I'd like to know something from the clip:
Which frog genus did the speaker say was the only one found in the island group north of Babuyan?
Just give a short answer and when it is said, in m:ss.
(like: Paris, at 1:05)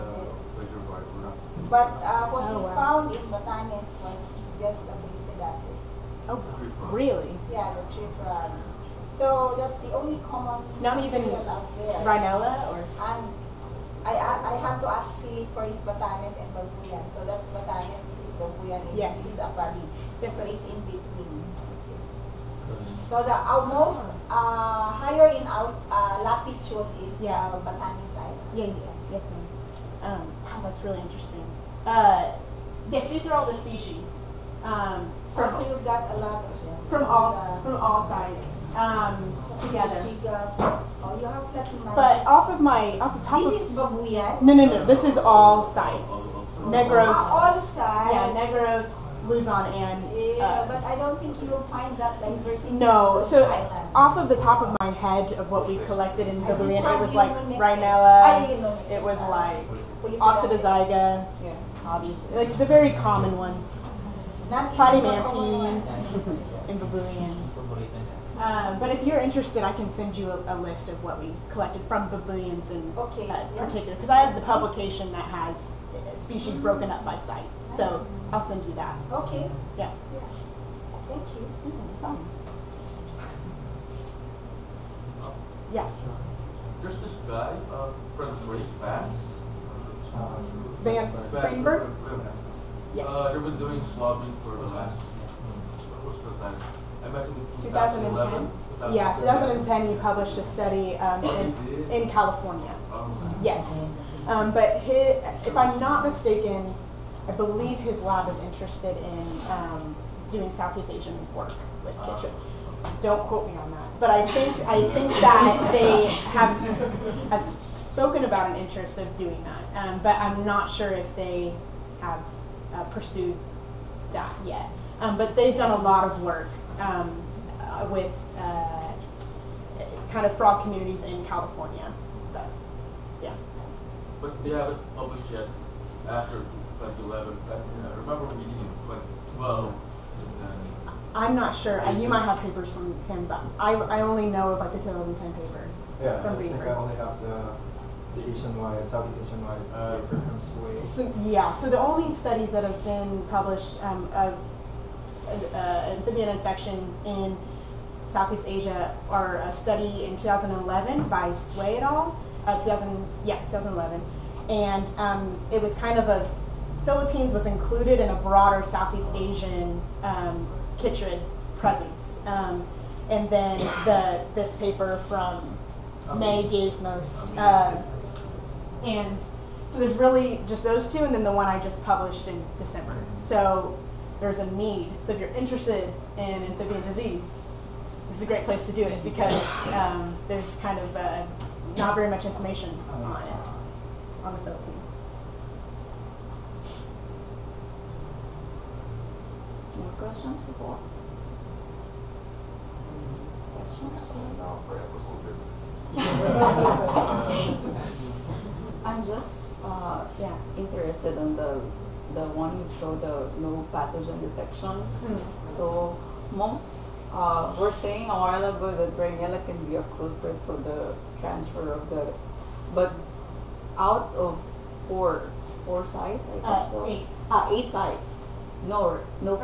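Polypedates, at 0:04.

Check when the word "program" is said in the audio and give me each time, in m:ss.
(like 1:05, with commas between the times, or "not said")
not said.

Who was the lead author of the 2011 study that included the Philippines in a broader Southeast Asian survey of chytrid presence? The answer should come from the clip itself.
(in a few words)
Swei.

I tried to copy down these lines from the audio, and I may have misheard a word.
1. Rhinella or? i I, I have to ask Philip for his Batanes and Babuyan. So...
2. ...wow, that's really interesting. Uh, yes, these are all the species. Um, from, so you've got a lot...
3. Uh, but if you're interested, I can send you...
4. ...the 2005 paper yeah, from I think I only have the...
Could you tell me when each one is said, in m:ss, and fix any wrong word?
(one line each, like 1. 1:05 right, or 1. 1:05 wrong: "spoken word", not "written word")
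1. 0:12 right
2. 0:30 right
3. 1:08 right
4. 2:24 wrong: "2010", not "2005".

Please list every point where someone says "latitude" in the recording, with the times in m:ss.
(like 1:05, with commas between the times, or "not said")
0:26.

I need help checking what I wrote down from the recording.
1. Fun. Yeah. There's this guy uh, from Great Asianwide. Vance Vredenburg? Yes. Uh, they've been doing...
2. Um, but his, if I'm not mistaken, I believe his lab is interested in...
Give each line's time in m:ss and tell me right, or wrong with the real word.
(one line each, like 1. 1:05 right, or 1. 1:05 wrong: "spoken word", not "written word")
1. 1:22 wrong: "Vance", not "Asianwide"
2. 1:44 right.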